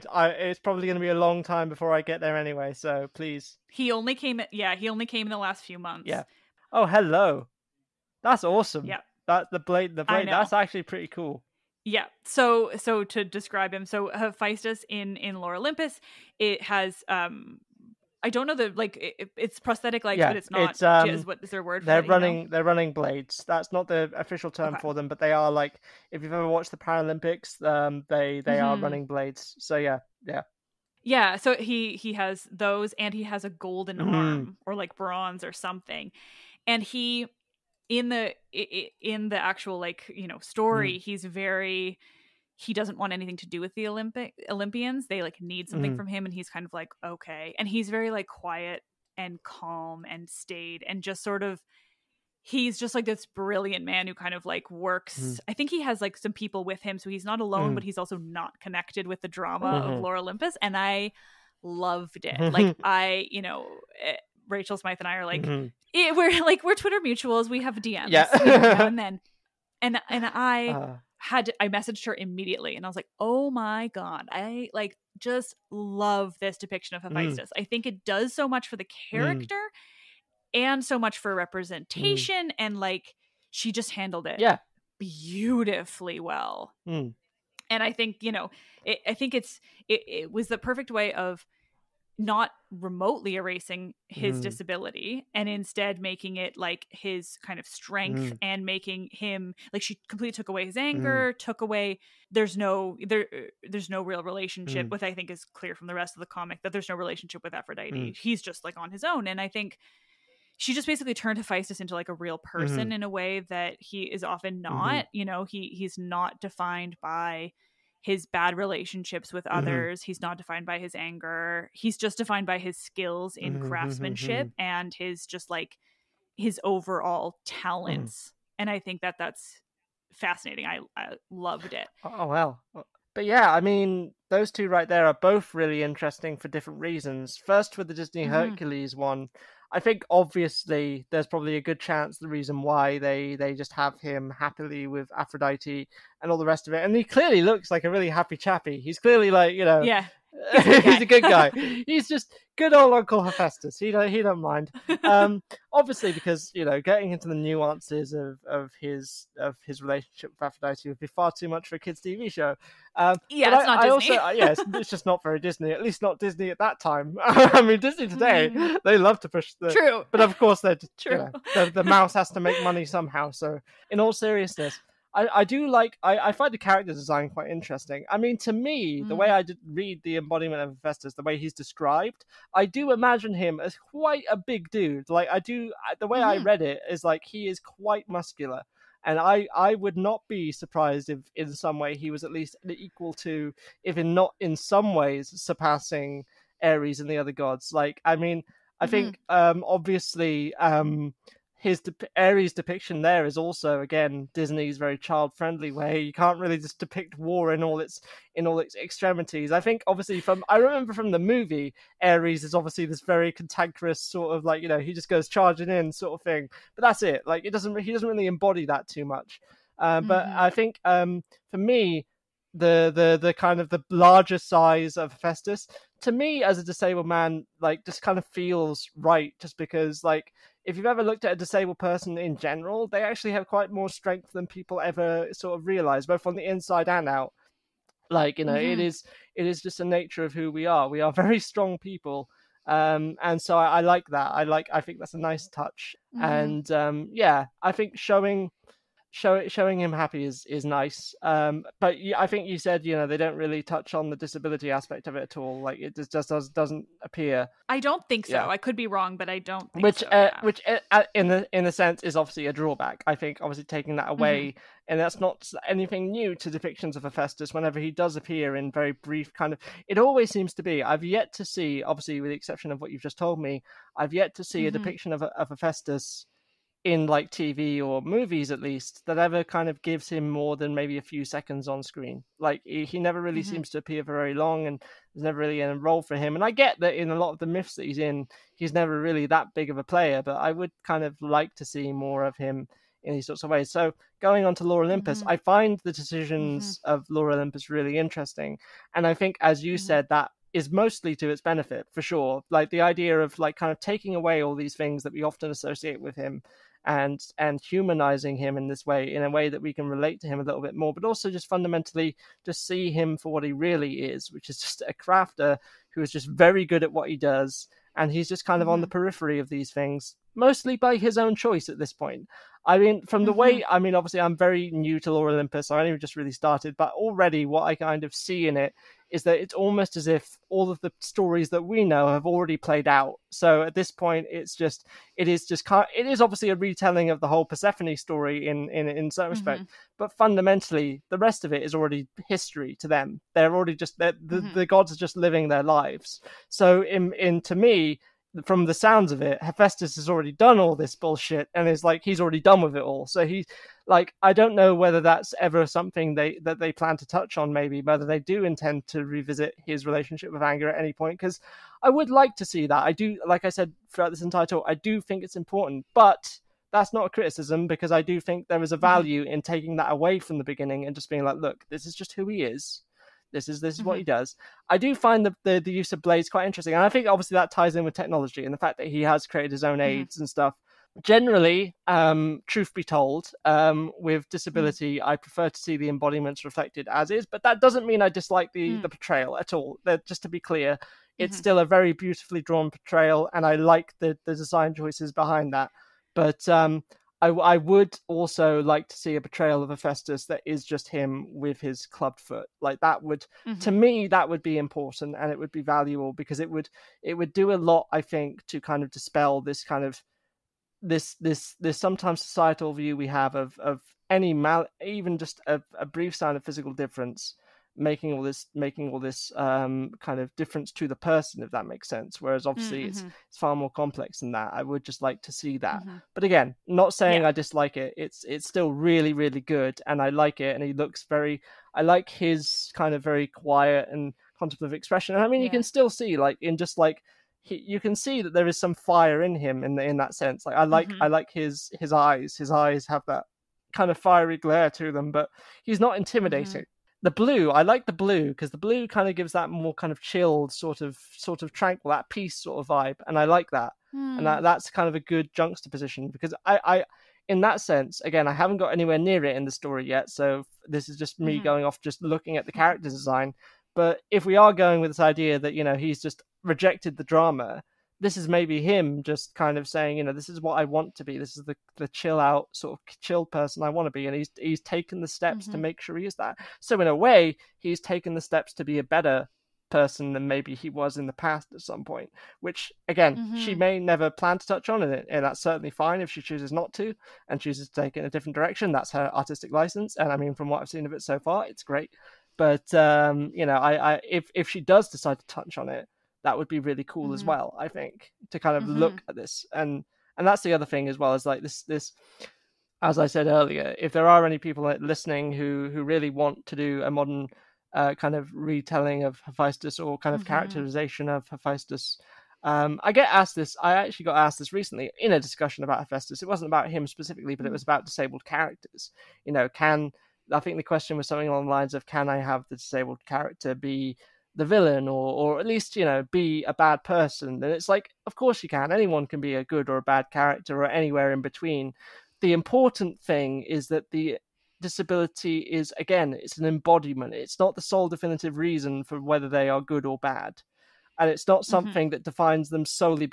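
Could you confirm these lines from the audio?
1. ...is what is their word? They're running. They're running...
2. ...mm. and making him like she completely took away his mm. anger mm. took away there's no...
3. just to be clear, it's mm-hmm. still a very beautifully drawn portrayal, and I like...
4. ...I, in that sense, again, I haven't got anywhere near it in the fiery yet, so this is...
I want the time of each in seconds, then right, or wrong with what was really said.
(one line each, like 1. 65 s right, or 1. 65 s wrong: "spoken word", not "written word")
1. 21 s right
2. 98 s right
3. 390 s right
4. 456 s wrong: "story", not "fiery".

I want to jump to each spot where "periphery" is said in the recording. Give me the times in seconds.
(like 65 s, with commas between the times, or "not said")
318 s.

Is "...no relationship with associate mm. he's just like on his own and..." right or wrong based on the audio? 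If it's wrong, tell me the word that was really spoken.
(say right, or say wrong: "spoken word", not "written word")
wrong: "aphrodite", not "associate".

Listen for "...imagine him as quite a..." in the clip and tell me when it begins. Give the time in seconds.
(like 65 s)
182 s.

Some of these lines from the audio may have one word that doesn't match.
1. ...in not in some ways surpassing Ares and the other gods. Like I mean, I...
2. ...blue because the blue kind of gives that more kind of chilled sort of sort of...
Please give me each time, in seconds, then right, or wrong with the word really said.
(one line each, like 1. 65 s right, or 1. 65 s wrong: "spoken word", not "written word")
1. 193 s right
2. 447 s right.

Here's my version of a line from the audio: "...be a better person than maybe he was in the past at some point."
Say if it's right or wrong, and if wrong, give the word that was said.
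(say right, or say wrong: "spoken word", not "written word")
right.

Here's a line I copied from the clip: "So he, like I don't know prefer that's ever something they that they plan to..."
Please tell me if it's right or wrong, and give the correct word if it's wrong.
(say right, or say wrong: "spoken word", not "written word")
wrong: "whether", not "prefer".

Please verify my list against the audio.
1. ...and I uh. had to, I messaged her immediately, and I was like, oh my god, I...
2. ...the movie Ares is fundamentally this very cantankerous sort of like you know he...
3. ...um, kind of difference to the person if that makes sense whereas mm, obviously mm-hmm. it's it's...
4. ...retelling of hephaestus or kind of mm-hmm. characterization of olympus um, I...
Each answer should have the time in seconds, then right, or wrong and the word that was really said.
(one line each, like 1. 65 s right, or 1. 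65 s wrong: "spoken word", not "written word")
1. 70 s right
2. 211 s wrong: "obviously", not "fundamentally"
3. 419 s right
4. 508 s wrong: "hephaestus", not "olympus".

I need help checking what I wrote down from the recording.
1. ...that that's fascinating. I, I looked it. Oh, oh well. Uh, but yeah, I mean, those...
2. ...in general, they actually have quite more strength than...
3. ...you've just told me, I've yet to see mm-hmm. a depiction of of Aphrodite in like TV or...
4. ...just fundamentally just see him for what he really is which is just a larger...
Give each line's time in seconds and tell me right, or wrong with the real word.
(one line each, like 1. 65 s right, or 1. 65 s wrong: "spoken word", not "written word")
1. 129 s wrong: "loved", not "looked"
2. 232 s right
3. 272 s wrong: "Hephaestus", not "Aphrodite"
4. 311 s wrong: "crafter", not "larger".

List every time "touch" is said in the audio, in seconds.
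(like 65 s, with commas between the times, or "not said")
245 s, 253 s, 357 s, 484 s, 495 s.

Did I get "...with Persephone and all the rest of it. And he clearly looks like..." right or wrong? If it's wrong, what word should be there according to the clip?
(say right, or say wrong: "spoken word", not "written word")
wrong: "Aphrodite", not "Persephone".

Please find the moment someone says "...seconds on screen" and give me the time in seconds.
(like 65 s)
281 s.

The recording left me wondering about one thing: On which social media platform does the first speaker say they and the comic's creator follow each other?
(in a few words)
Twitter.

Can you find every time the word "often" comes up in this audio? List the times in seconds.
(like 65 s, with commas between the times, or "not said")
114 s, 305 s.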